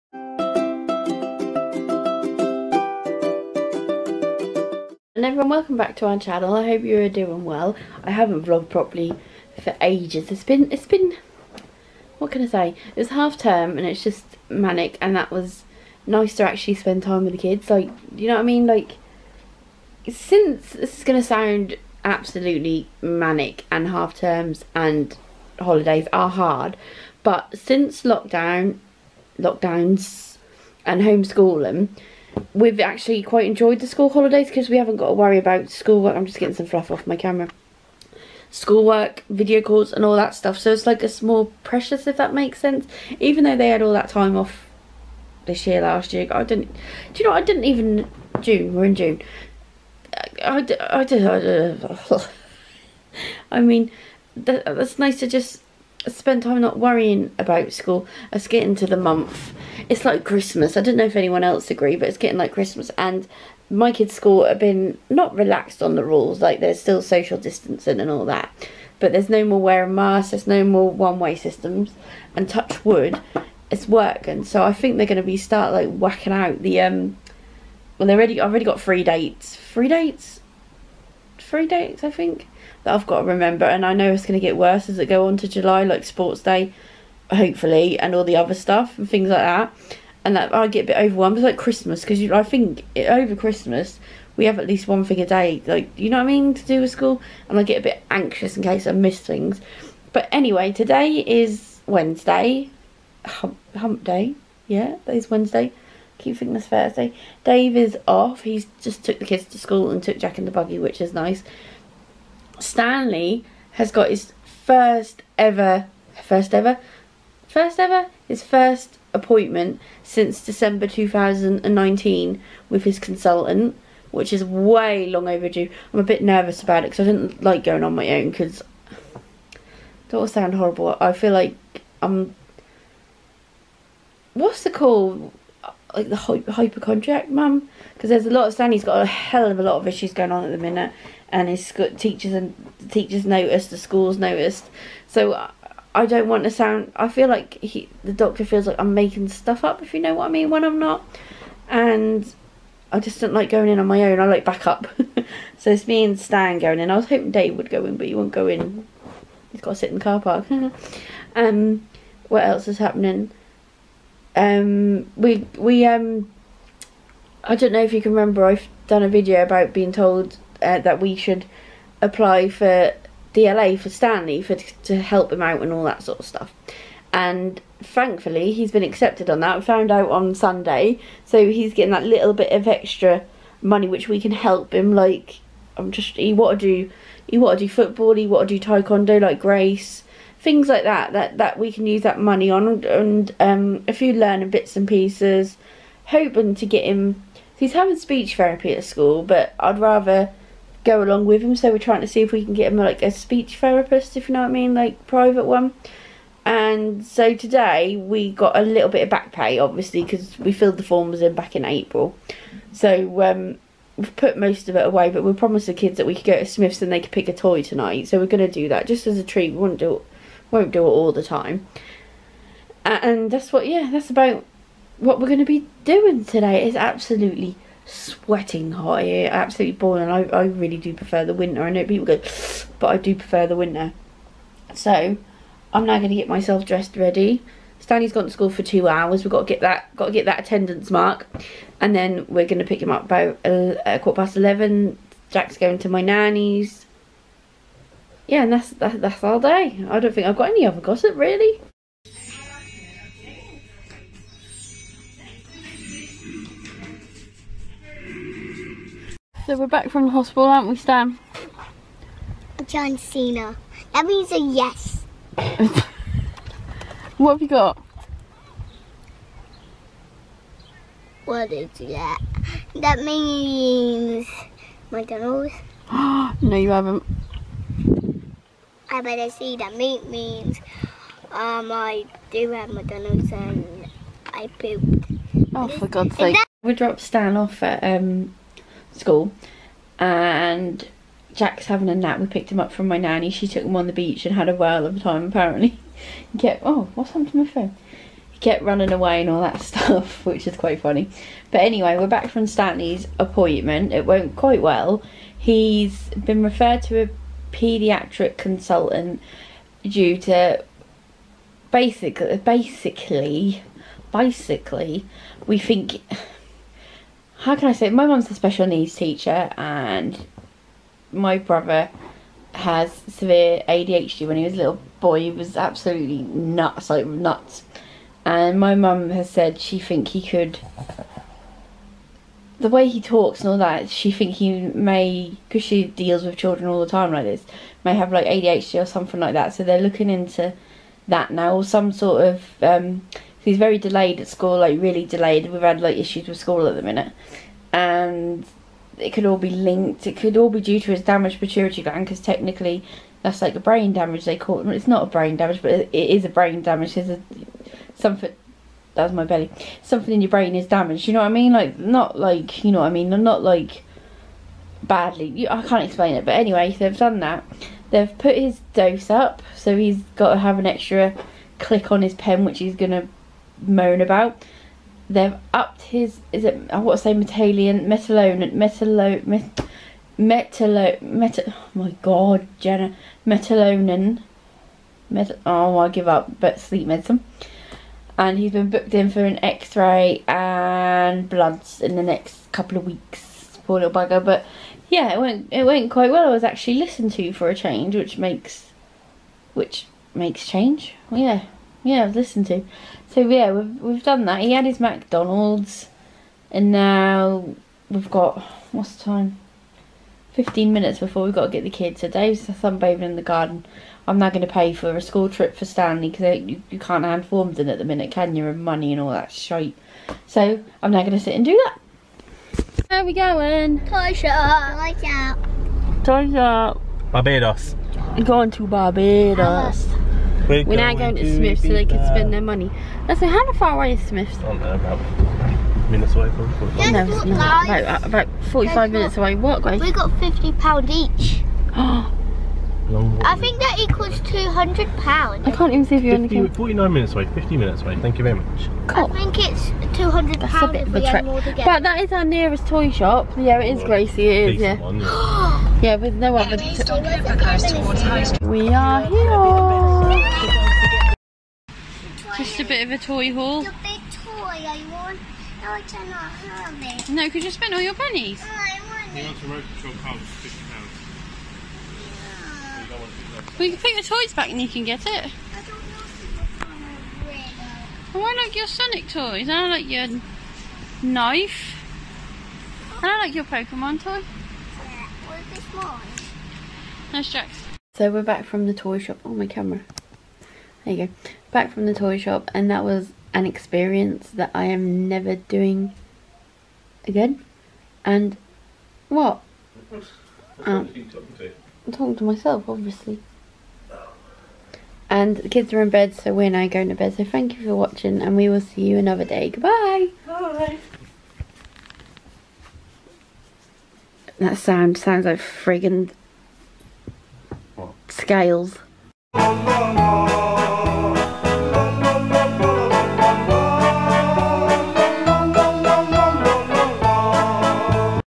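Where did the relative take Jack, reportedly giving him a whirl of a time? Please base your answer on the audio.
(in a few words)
The beach.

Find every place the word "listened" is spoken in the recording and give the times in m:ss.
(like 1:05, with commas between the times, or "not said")
6:36, 6:42.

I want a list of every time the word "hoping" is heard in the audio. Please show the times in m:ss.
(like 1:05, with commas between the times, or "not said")
2:37, 3:16.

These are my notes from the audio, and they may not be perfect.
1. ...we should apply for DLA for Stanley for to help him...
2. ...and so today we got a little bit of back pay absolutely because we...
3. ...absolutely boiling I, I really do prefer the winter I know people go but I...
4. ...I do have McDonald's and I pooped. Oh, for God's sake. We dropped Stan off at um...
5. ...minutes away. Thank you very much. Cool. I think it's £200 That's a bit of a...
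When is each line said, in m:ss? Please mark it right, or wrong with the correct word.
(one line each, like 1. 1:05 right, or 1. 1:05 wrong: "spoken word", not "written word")
1. 2:50 right
2. 3:26 wrong: "obviously", not "absolutely"
3. 3:49 right
4. 4:41 right
5. 7:27 right.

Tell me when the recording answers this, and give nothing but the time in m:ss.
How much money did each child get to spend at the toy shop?
7:20.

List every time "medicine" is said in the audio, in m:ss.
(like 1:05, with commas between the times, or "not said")
6:26.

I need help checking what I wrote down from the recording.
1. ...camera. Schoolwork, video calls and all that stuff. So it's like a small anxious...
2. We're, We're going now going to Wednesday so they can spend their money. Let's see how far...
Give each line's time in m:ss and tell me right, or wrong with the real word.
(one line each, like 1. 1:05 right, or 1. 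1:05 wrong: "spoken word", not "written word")
1. 0:37 wrong: "precious", not "anxious"
2. 7:10 wrong: "Smyths", not "Wednesday".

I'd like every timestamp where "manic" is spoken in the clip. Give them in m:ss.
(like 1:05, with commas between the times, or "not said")
0:14, 0:23.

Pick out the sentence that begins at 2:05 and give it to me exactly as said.
I'm a bit nervous about it because I didn't like going on my own because don't sound horrible.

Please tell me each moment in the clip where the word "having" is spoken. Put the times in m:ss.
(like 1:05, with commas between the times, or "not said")
3:17, 4:51.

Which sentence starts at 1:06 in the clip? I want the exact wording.
Like there's still social distancing and all that.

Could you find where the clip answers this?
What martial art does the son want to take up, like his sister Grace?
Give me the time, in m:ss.
3:08.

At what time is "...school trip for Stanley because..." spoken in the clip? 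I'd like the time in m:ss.
6:55.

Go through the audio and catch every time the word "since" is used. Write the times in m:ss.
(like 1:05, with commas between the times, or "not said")
0:20, 0:27, 2:00.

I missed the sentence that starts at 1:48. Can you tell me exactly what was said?
He's just took the kids to school and took Jack in the buggy, which is nice.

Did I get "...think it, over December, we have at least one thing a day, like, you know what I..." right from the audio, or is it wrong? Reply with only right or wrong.
wrong.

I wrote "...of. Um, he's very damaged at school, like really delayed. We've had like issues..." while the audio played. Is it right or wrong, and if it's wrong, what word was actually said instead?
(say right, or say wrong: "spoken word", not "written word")
wrong: "delayed", not "damaged".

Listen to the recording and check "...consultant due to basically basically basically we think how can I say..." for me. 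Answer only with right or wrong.
right.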